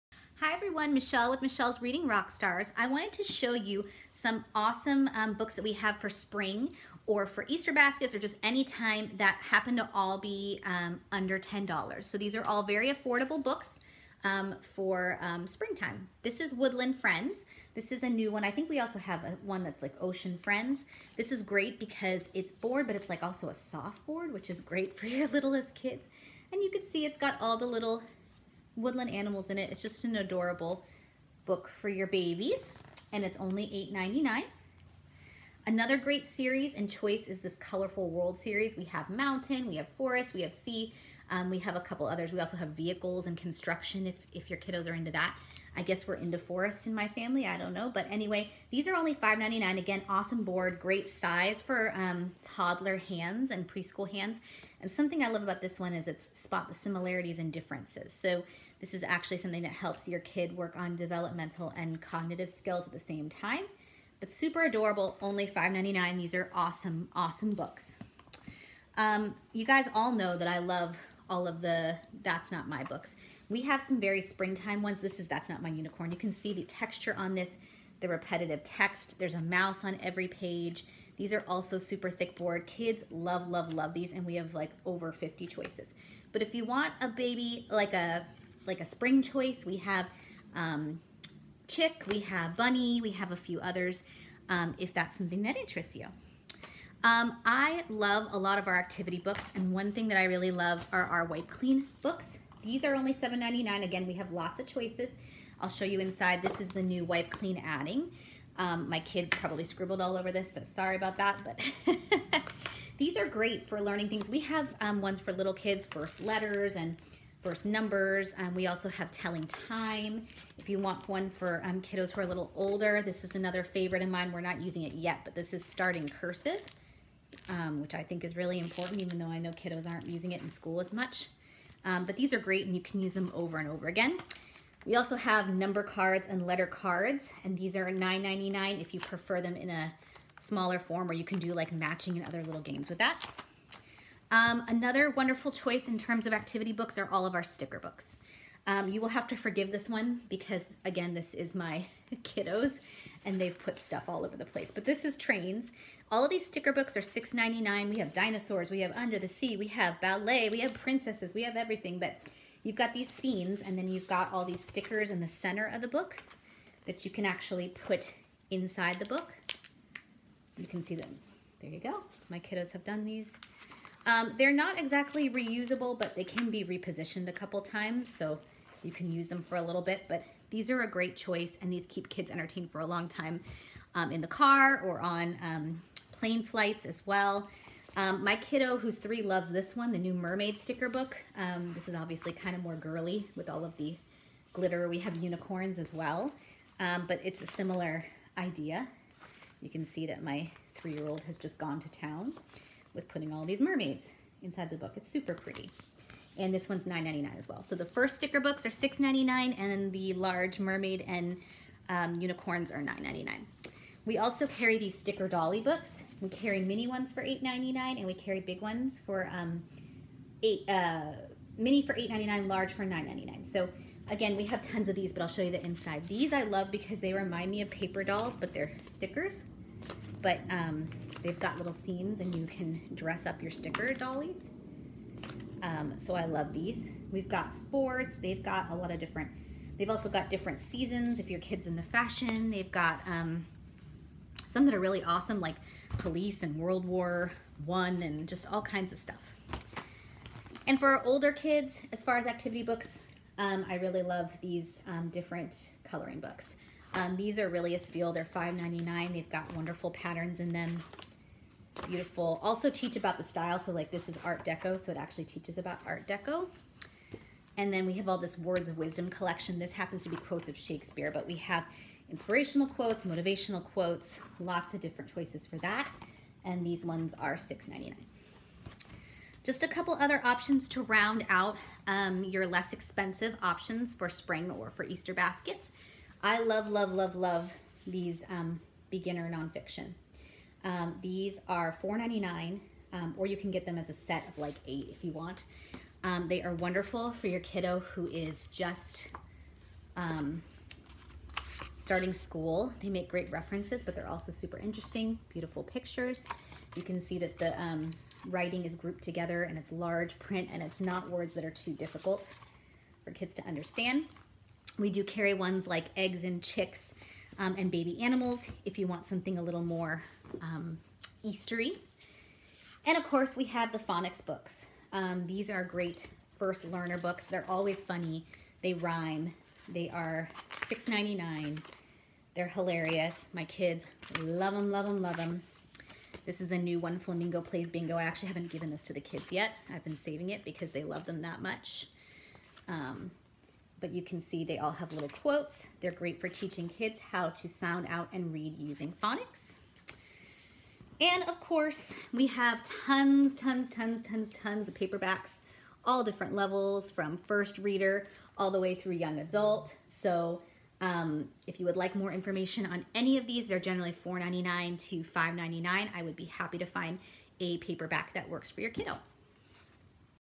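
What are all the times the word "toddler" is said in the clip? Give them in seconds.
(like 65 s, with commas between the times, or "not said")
52 s.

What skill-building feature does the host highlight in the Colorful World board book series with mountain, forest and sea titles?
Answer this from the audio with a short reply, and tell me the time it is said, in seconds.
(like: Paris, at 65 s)
spot the similarities and differences, at 56 s.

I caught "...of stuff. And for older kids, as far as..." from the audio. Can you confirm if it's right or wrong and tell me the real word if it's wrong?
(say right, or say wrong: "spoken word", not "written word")
right.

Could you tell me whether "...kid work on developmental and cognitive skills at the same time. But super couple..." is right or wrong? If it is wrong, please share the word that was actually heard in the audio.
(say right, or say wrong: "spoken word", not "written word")
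wrong: "adorable", not "couple".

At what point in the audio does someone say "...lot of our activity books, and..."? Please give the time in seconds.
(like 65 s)
98 s.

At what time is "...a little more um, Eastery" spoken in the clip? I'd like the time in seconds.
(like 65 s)
319 s.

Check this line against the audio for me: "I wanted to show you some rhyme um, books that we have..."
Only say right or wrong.
wrong.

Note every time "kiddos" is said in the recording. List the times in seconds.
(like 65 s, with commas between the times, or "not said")
44 s, 121 s, 129 s, 152 s, 172 s, 188 s, 297 s, 368 s.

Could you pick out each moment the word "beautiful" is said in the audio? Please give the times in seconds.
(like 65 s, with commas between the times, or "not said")
261 s, 305 s.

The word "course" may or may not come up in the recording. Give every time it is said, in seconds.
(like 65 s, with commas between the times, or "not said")
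323 s, 351 s.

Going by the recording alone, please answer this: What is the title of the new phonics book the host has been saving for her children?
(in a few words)
Flamingo Plays Bingo.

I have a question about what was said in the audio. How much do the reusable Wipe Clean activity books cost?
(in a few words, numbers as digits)
$7.99.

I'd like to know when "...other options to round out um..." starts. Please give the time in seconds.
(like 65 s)
279 s.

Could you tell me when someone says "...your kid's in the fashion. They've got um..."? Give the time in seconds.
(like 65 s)
241 s.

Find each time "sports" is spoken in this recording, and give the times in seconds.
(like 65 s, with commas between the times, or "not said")
237 s.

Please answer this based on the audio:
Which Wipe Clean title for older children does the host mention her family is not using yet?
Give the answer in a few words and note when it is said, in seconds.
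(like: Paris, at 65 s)
starting cursive, at 125 s.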